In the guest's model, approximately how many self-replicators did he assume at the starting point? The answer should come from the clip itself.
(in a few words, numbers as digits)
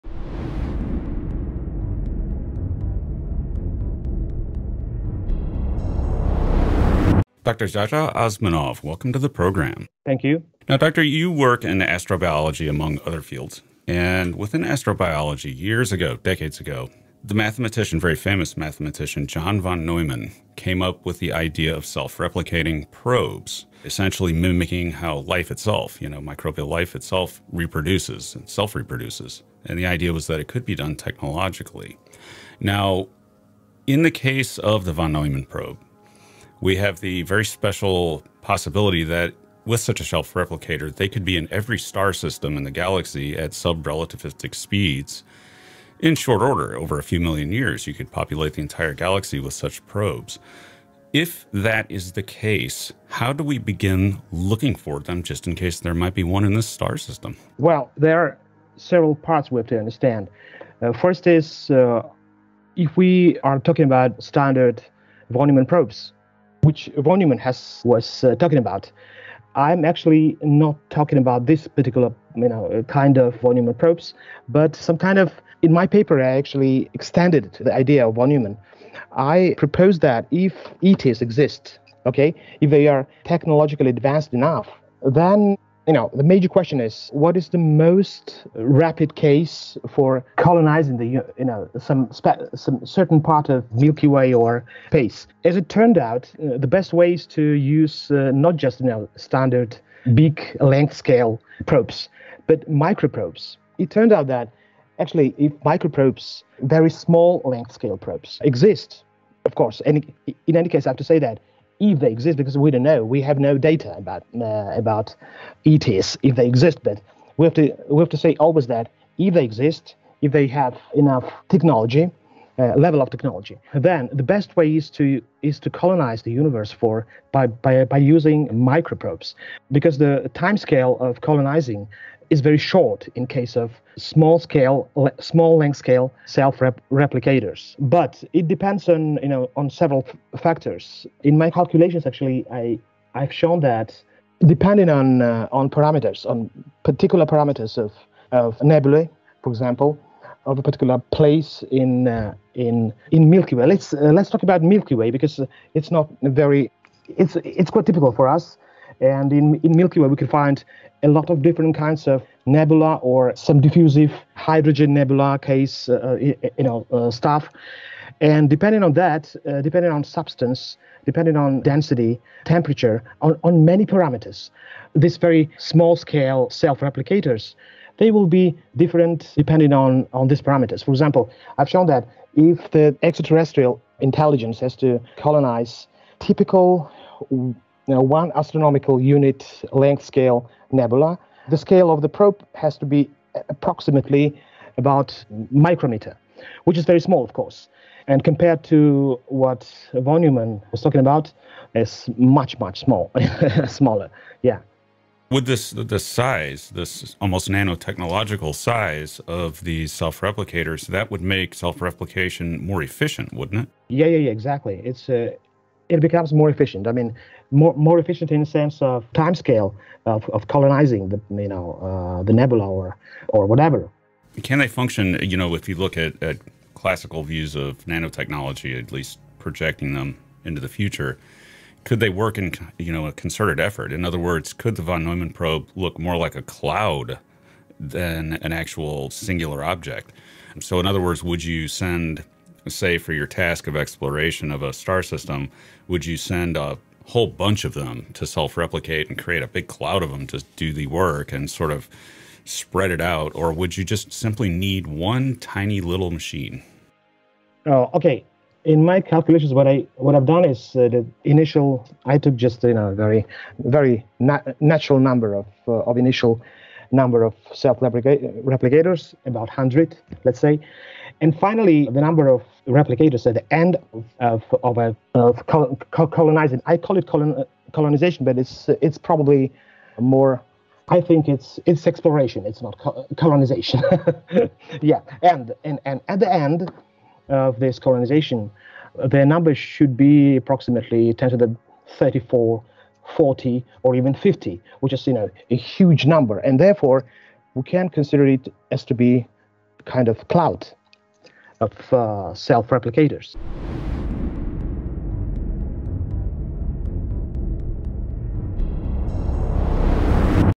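100.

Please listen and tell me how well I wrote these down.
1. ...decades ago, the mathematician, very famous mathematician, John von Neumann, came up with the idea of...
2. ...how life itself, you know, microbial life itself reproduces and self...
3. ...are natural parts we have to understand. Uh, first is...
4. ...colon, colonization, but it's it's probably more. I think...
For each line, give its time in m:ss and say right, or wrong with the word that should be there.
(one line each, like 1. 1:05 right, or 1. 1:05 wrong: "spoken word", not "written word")
1. 0:16 right
2. 0:24 right
3. 0:58 wrong: "several", not "natural"
4. 4:37 right.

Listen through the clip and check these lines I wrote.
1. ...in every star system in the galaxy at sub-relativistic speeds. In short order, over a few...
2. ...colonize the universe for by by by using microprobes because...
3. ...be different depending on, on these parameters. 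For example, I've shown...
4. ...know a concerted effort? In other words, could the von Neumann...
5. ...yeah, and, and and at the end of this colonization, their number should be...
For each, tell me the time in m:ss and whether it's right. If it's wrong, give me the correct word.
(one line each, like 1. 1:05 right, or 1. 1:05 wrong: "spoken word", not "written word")
1. 0:41 right
2. 2:05 right
3. 2:58 right
4. 3:52 right
5. 4:44 right.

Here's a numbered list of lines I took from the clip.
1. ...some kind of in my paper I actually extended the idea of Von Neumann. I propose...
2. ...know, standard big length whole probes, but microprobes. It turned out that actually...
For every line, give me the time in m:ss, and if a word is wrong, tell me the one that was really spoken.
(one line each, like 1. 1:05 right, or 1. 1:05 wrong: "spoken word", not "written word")
1. 1:14 right
2. 1:38 wrong: "scale", not "whole".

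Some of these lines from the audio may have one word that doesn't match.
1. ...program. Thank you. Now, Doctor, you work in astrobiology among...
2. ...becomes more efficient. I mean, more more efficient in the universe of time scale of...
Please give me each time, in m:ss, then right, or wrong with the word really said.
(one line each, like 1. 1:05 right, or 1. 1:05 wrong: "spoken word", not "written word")
1. 0:09 right
2. 3:35 wrong: "sense", not "universe".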